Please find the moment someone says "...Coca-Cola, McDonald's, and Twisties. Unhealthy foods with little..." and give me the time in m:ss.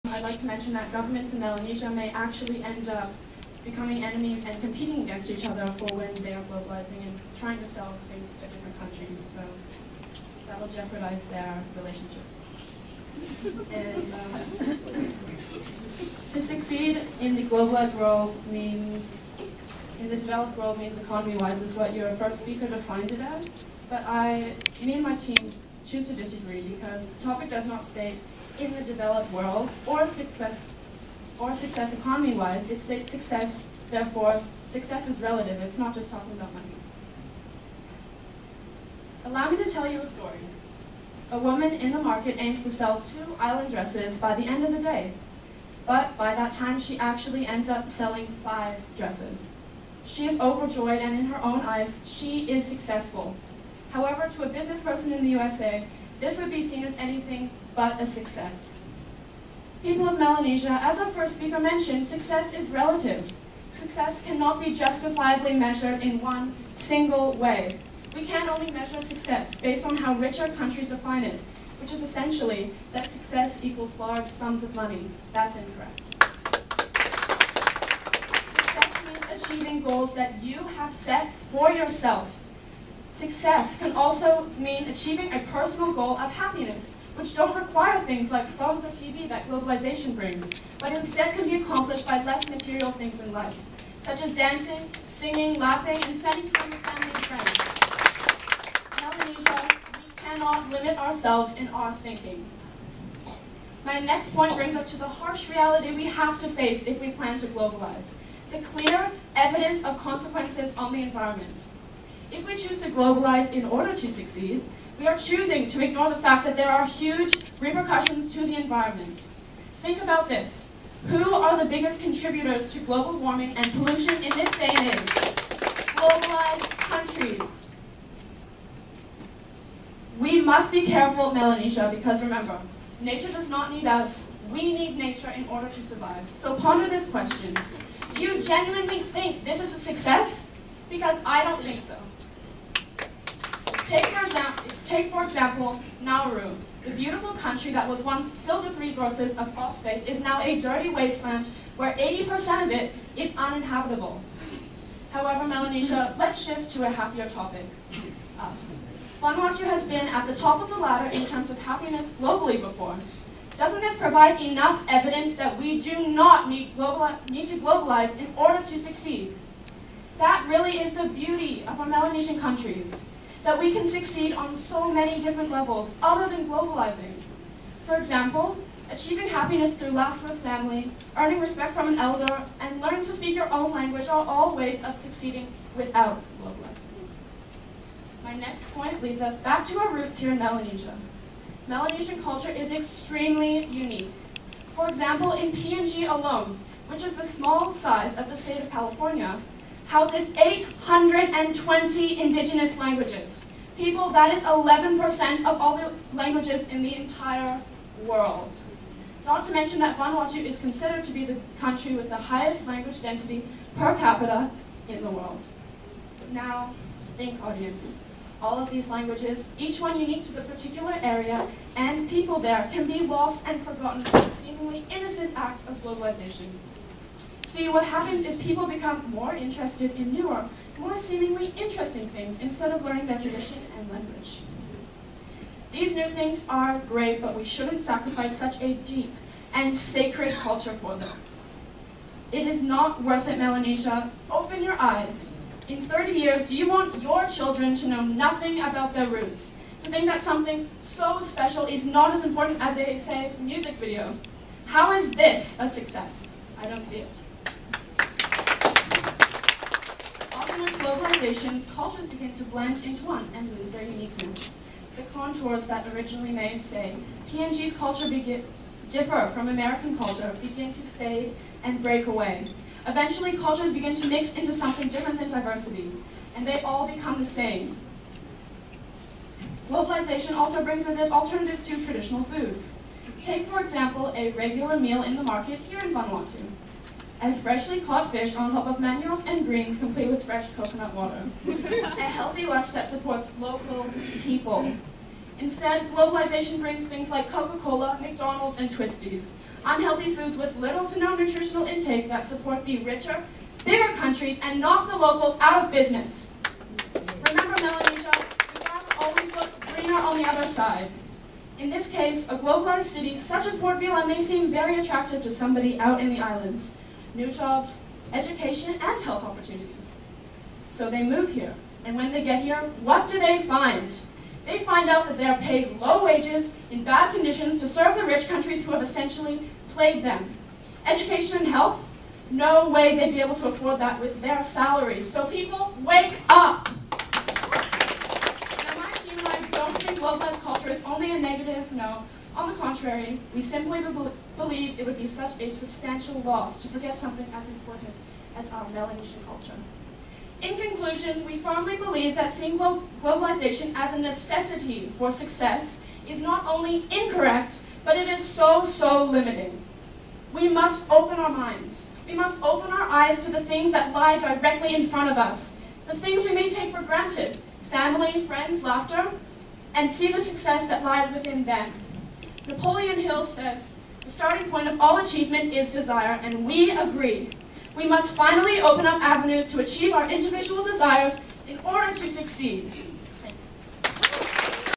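4:57.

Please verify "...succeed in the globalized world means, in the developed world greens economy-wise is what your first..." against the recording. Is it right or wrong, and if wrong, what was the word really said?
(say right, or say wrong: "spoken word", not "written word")
wrong: "means", not "greens".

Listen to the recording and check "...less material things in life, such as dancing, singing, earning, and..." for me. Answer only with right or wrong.
wrong.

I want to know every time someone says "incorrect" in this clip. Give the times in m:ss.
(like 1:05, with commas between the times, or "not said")
1:15, 5:56.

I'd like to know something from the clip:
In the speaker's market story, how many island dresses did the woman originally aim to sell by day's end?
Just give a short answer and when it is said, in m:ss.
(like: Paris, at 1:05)
2, at 0:43.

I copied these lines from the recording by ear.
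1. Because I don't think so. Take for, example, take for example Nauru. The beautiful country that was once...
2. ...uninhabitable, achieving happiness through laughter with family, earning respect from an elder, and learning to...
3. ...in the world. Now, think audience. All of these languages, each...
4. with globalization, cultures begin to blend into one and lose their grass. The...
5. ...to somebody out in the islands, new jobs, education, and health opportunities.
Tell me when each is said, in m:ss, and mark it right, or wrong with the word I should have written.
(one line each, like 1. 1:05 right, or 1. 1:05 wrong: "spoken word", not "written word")
1. 2:20 right
2. 2:57 wrong: "example", not "uninhabitable"
3. 3:34 right
4. 4:20 wrong: "uniqueness", not "grass"
5. 5:15 right.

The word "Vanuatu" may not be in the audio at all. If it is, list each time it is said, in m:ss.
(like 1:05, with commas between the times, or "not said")
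2:39, 3:29, 4:45.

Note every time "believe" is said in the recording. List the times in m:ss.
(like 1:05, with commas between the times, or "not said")
5:44, 5:51.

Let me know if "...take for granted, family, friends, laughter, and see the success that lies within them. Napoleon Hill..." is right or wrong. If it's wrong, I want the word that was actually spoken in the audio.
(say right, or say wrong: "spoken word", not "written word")
right.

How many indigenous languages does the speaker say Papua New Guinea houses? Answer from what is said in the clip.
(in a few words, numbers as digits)
820.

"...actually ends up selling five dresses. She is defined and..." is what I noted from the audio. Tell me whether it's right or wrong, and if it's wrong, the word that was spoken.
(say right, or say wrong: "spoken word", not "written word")
wrong: "overjoyed", not "defined".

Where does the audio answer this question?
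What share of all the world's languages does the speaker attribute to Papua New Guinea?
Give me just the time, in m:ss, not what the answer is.
3:24.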